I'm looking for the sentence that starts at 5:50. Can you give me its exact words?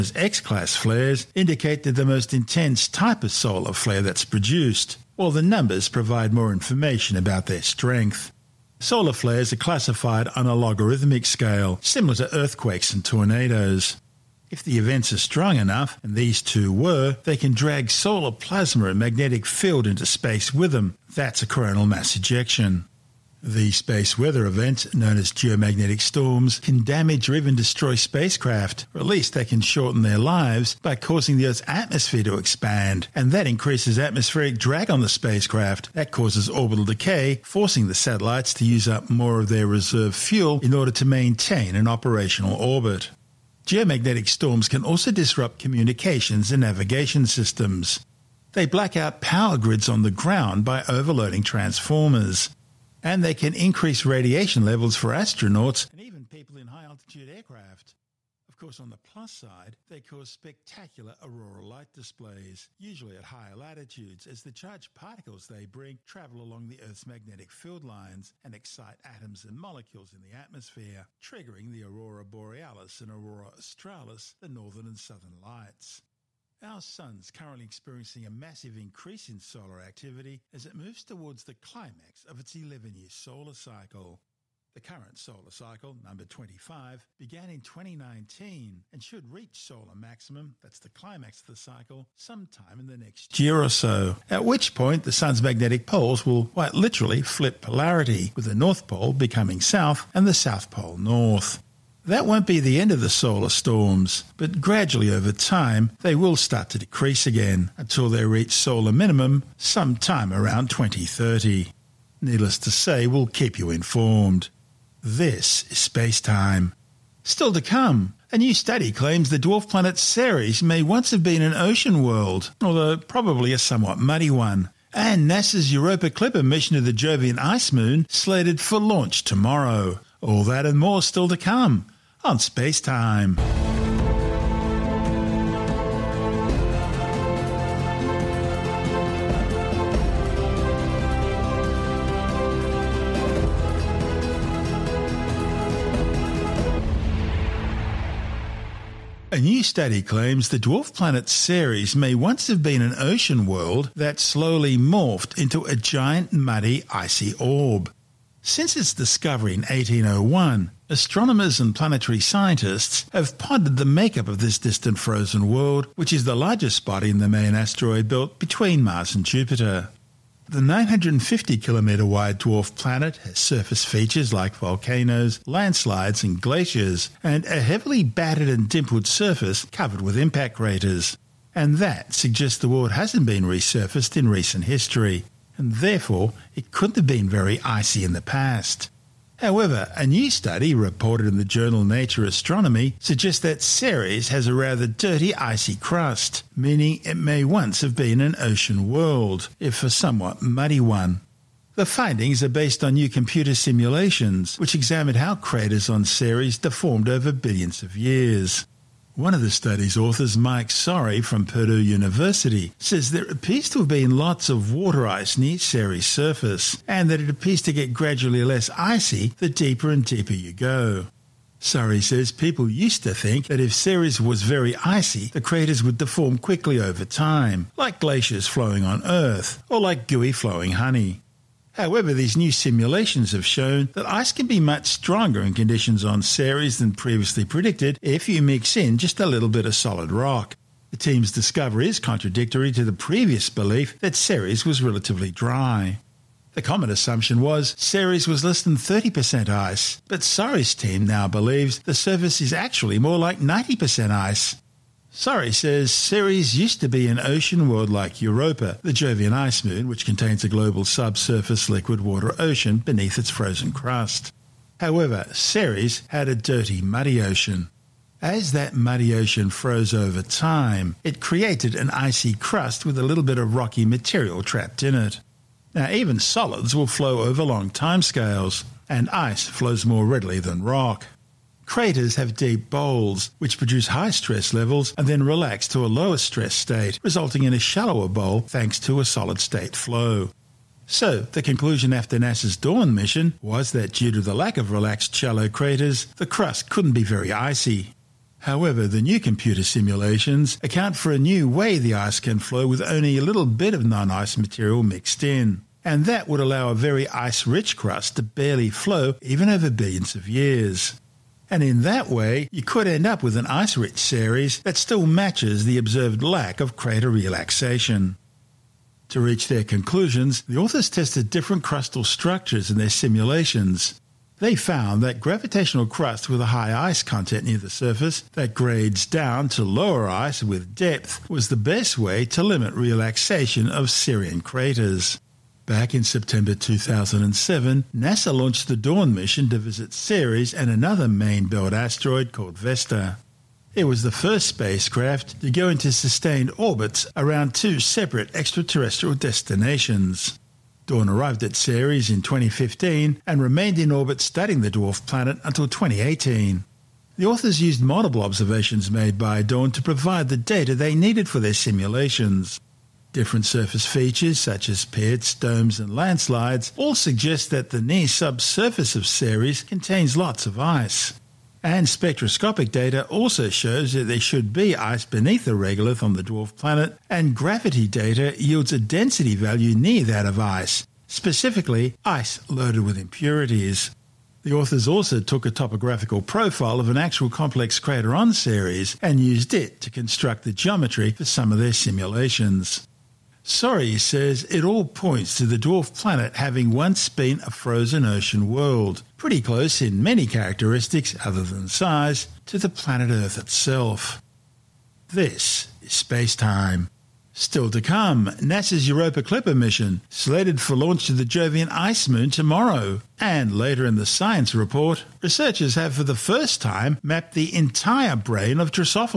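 Dawn arrived at Ceres in 2015 and remained in orbit studying the dwarf planet until 2018.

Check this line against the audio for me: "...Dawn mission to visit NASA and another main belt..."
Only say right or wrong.
wrong.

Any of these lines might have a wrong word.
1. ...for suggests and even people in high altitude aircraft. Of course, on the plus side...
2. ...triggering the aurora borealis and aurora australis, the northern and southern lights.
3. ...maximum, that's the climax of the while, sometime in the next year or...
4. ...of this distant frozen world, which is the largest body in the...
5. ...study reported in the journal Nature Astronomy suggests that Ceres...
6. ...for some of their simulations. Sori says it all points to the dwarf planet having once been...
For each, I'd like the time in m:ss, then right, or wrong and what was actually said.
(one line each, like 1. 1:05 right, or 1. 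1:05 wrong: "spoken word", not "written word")
1. 0:54 wrong: "astronauts", not "suggests"
2. 1:11 right
3. 1:29 wrong: "cycle", not "while"
4. 2:44 right
5. 3:10 right
6. 6:31 right.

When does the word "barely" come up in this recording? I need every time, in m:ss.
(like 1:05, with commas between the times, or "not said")
5:08.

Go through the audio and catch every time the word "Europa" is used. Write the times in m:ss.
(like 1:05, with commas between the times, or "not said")
2:05, 4:18, 6:48.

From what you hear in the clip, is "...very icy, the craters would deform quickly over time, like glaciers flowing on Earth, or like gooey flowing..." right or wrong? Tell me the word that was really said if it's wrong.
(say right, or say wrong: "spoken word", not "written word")
right.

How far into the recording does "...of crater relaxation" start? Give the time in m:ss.
5:16.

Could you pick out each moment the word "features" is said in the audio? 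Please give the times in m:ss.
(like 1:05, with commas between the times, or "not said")
2:53, 6:03.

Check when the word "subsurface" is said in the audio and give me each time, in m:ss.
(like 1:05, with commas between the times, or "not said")
4:20, 6:08.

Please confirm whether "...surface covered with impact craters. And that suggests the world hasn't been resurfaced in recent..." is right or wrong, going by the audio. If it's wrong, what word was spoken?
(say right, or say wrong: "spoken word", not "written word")
right.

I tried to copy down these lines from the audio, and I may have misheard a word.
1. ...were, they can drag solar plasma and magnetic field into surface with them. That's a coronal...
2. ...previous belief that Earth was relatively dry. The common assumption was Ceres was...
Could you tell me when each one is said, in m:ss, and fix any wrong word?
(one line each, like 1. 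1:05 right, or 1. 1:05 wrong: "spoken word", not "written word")
1. 0:16 wrong: "space", not "surface"
2. 4:02 wrong: "Ceres", not "Earth".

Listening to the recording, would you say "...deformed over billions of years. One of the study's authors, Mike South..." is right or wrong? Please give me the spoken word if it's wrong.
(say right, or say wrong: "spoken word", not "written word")
wrong: "Sori", not "South".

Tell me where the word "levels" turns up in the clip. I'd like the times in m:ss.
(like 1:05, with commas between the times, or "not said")
0:54, 4:44.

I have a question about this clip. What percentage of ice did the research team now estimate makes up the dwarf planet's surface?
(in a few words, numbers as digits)
90%.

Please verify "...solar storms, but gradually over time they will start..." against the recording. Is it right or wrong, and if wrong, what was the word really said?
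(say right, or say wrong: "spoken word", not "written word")
right.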